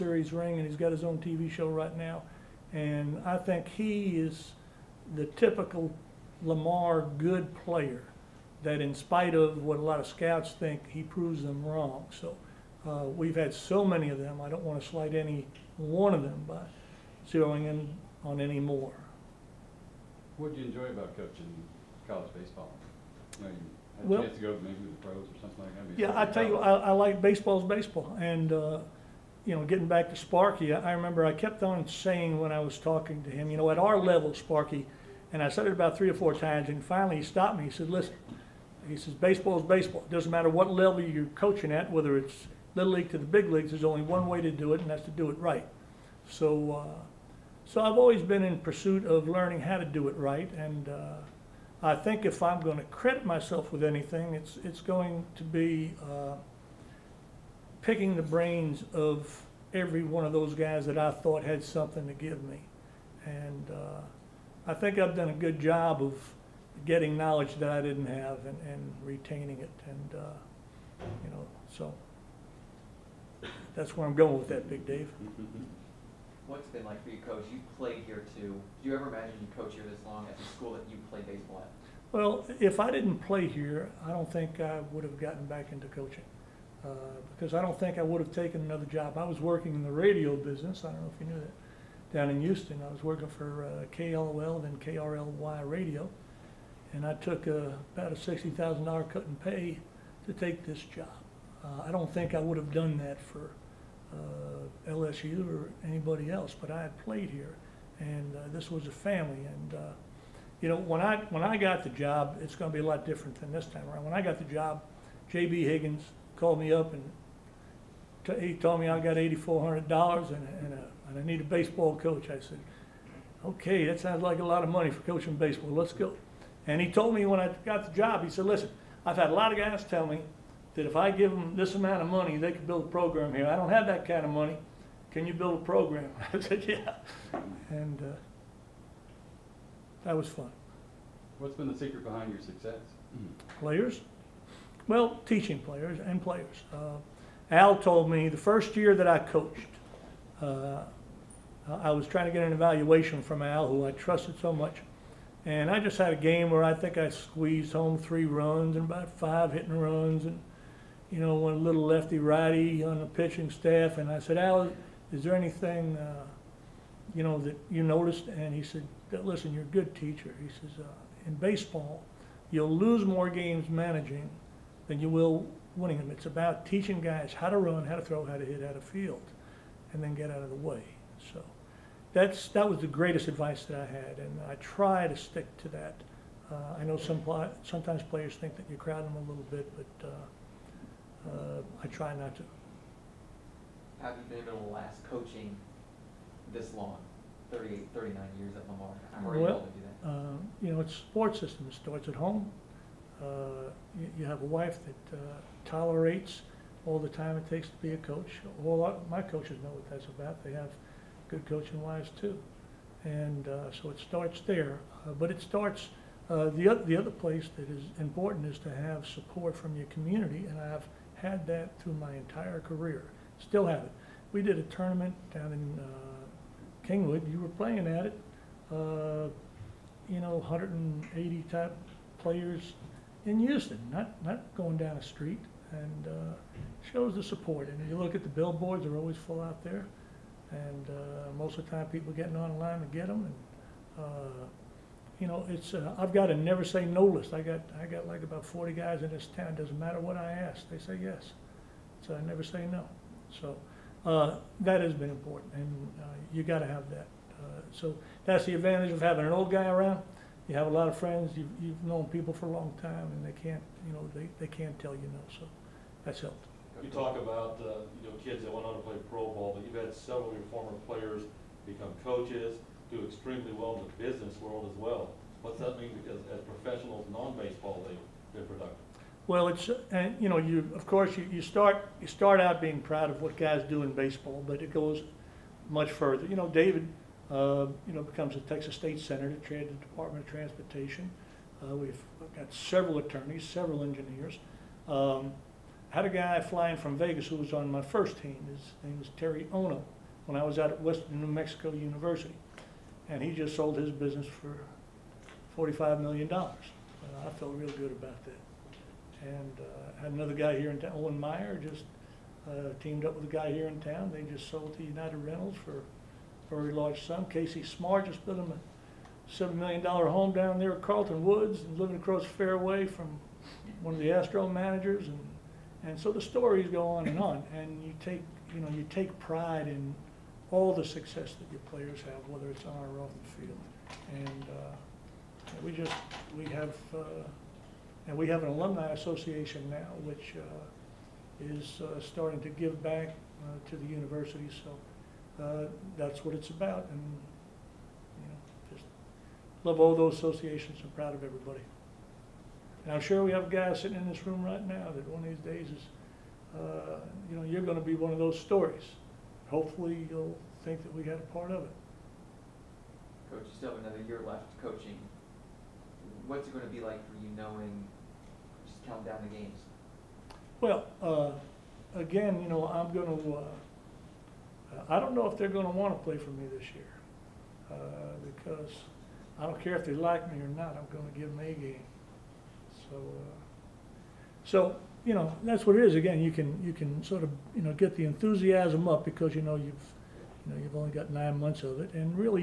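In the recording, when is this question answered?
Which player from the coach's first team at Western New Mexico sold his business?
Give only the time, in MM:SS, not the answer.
04:59.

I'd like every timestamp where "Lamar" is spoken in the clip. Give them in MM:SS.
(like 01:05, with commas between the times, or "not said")
00:06, 03:18.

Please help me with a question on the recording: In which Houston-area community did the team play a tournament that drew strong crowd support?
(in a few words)
Kingwood.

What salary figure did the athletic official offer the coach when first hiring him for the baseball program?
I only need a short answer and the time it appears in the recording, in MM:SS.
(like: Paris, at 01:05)
$8,400, at 01:59.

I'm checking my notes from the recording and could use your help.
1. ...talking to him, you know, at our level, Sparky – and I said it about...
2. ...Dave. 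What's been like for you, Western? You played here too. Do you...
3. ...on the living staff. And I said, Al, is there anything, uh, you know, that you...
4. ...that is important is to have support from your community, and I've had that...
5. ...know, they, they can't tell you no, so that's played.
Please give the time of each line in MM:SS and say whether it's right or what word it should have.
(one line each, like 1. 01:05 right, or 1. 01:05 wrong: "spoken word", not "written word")
1. 00:32 right
2. 01:14 wrong: "Coach", not "Western"
3. 02:42 wrong: "pitching", not "living"
4. 03:37 right
5. 04:23 wrong: "helped", not "played".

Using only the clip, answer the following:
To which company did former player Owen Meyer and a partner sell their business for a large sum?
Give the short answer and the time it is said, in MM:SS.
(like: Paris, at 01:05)
United Rentals, at 05:14.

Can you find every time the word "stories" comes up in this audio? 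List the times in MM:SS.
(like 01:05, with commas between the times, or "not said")
05:26, 05:58.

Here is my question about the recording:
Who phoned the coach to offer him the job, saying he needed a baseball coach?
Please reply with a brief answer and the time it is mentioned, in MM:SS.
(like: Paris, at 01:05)
J.B. Higgins, at 01:55.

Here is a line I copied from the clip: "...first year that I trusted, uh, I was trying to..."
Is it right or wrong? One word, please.
wrong.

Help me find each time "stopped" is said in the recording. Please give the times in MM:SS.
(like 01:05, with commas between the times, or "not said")
00:37.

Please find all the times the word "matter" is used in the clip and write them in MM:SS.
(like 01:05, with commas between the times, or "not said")
00:40, 04:09.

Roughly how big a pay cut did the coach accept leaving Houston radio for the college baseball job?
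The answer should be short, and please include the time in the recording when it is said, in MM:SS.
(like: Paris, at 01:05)
$60,000, at 01:38.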